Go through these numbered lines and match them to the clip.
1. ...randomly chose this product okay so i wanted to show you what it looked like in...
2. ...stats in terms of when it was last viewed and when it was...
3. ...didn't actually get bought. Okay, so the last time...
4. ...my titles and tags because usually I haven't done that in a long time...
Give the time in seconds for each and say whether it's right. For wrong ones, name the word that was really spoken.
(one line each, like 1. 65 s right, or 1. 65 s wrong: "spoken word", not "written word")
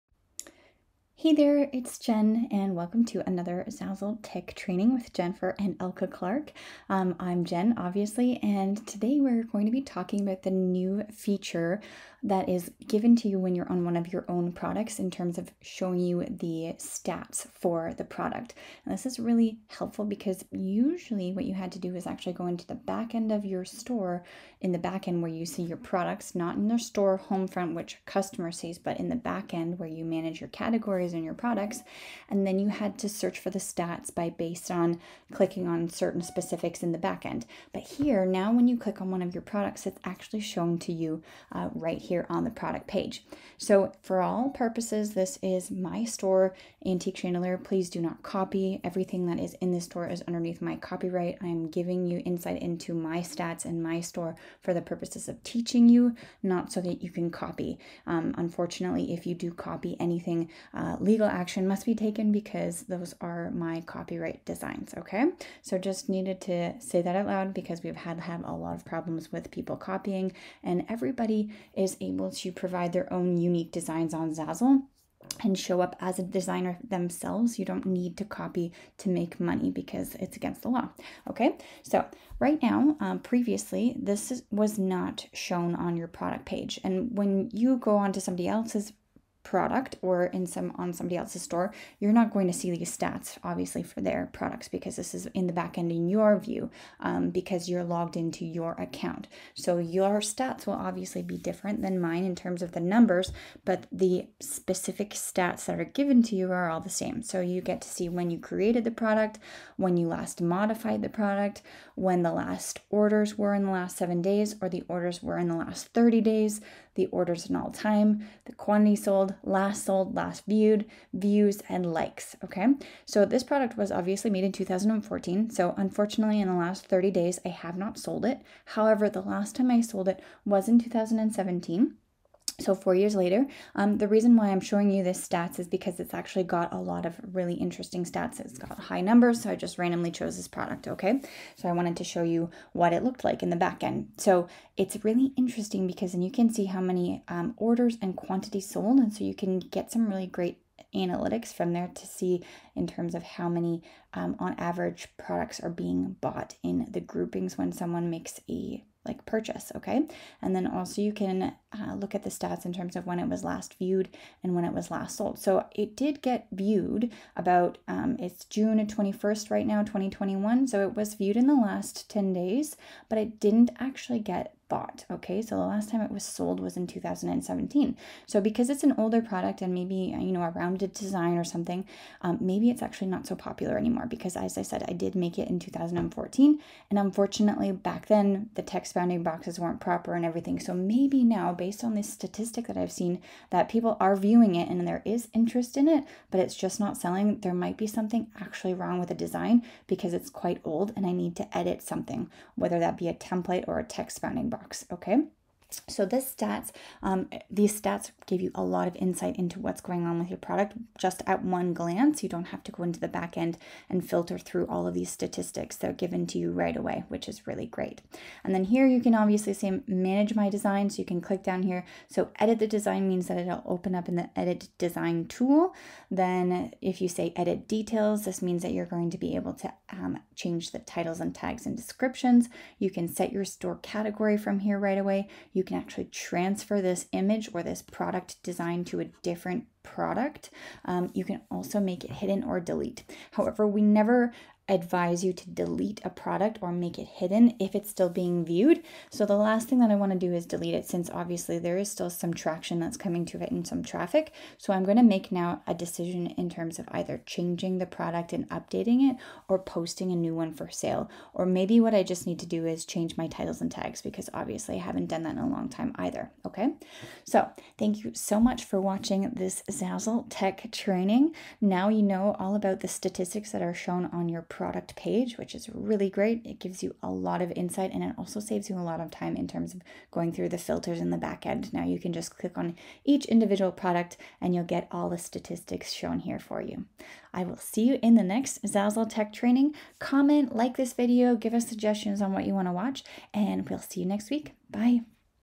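1. 139 s right
2. 162 s right
3. 173 s right
4. 263 s wrong: "obviously", not "usually".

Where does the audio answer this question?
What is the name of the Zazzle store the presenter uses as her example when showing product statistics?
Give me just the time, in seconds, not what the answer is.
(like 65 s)
46 s.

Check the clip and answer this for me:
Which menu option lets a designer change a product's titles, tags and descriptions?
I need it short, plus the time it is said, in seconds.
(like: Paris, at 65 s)
edit details, at 227 s.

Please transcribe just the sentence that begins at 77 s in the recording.
You don't need to copy to make money because it's against the law.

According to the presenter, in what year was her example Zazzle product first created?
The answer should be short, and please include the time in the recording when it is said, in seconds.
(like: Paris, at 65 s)
2014, at 124 s.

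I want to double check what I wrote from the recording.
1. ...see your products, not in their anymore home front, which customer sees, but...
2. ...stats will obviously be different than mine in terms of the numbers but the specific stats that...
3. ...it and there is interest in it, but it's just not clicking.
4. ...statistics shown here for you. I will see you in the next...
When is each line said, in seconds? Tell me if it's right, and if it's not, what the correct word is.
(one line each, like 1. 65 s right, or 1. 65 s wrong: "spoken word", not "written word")
1. 25 s wrong: "store", not "anymore"
2. 100 s right
3. 194 s wrong: "selling", not "clicking"
4. 285 s right.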